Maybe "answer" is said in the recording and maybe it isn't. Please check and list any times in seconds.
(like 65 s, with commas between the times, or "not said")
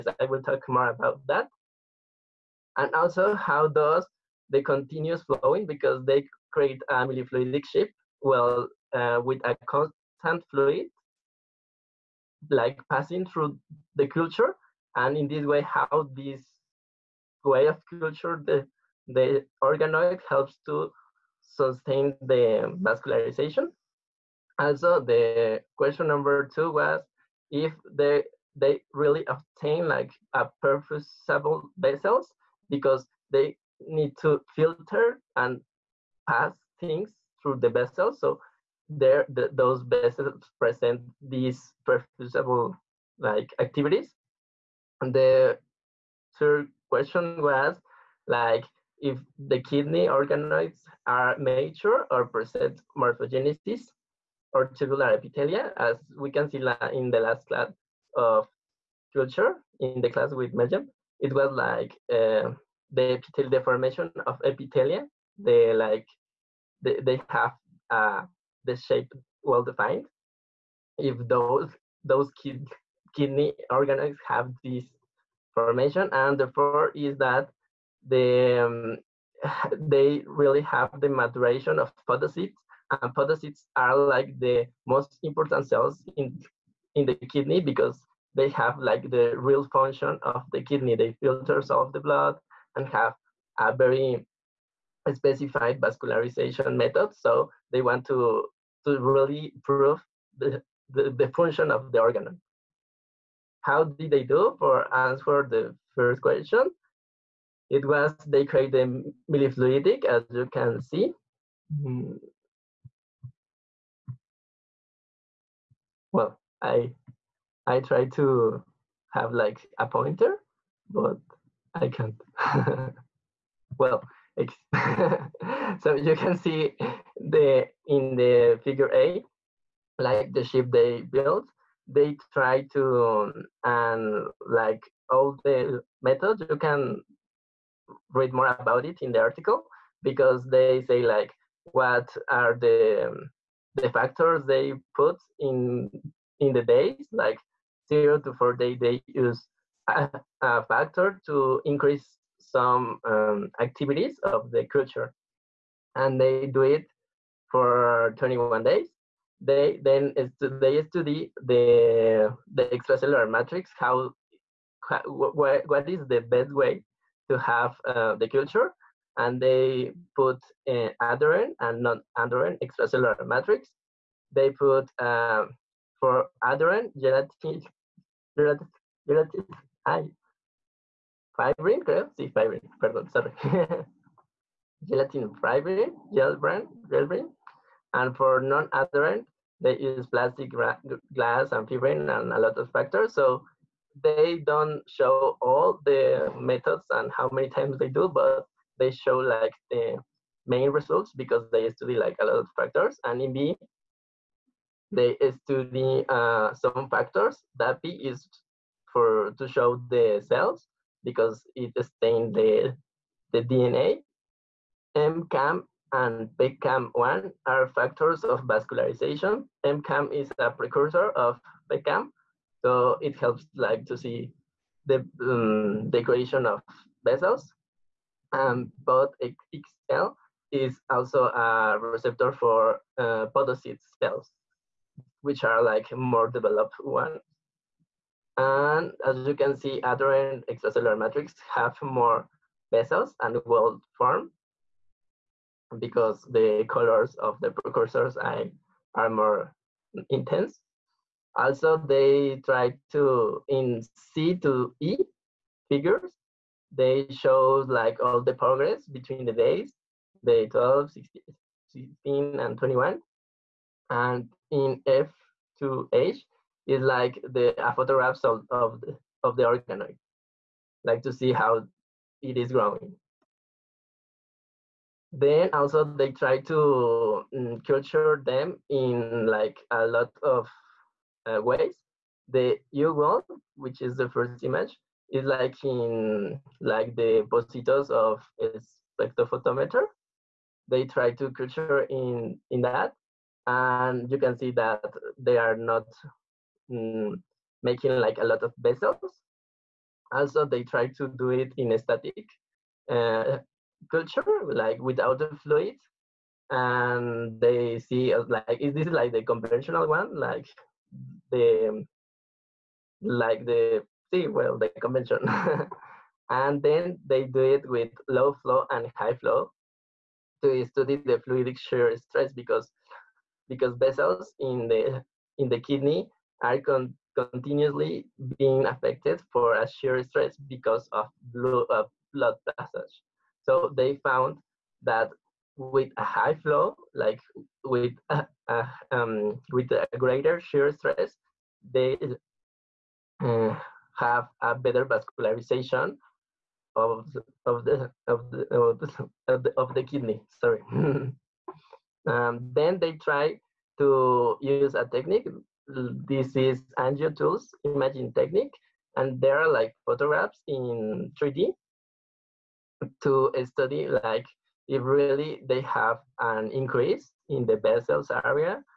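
104 s.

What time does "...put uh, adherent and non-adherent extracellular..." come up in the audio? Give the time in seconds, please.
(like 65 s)
170 s.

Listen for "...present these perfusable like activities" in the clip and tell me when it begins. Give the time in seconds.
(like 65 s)
40 s.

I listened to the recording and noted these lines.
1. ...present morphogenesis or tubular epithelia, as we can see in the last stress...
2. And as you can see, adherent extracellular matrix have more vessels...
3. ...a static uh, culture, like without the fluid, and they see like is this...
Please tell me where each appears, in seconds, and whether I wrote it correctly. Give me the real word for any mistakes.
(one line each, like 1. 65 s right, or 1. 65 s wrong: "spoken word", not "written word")
1. 52 s wrong: "class", not "stress"
2. 238 s right
3. 301 s right.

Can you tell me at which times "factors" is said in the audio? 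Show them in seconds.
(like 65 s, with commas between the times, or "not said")
143 s, 150 s, 192 s, 202 s, 206 s, 217 s.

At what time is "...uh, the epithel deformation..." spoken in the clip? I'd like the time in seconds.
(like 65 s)
62 s.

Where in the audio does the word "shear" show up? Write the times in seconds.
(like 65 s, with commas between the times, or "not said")
321 s, 329 s, 340 s.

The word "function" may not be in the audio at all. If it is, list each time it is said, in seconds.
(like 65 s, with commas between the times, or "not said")
89 s, 101 s.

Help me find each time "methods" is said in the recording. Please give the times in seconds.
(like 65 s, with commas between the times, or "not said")
96 s, 136 s, 196 s.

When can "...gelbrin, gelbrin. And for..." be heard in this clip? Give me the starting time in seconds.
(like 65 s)
186 s.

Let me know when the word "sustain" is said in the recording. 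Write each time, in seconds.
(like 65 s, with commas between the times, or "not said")
21 s.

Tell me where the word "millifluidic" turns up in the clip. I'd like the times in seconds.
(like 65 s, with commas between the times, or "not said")
6 s, 109 s.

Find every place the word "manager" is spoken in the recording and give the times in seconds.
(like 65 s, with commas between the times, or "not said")
not said.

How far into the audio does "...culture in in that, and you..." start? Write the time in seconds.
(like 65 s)
291 s.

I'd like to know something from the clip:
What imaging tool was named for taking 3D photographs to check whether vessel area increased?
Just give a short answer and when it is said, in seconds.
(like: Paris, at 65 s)
AngioTools, at 356 s.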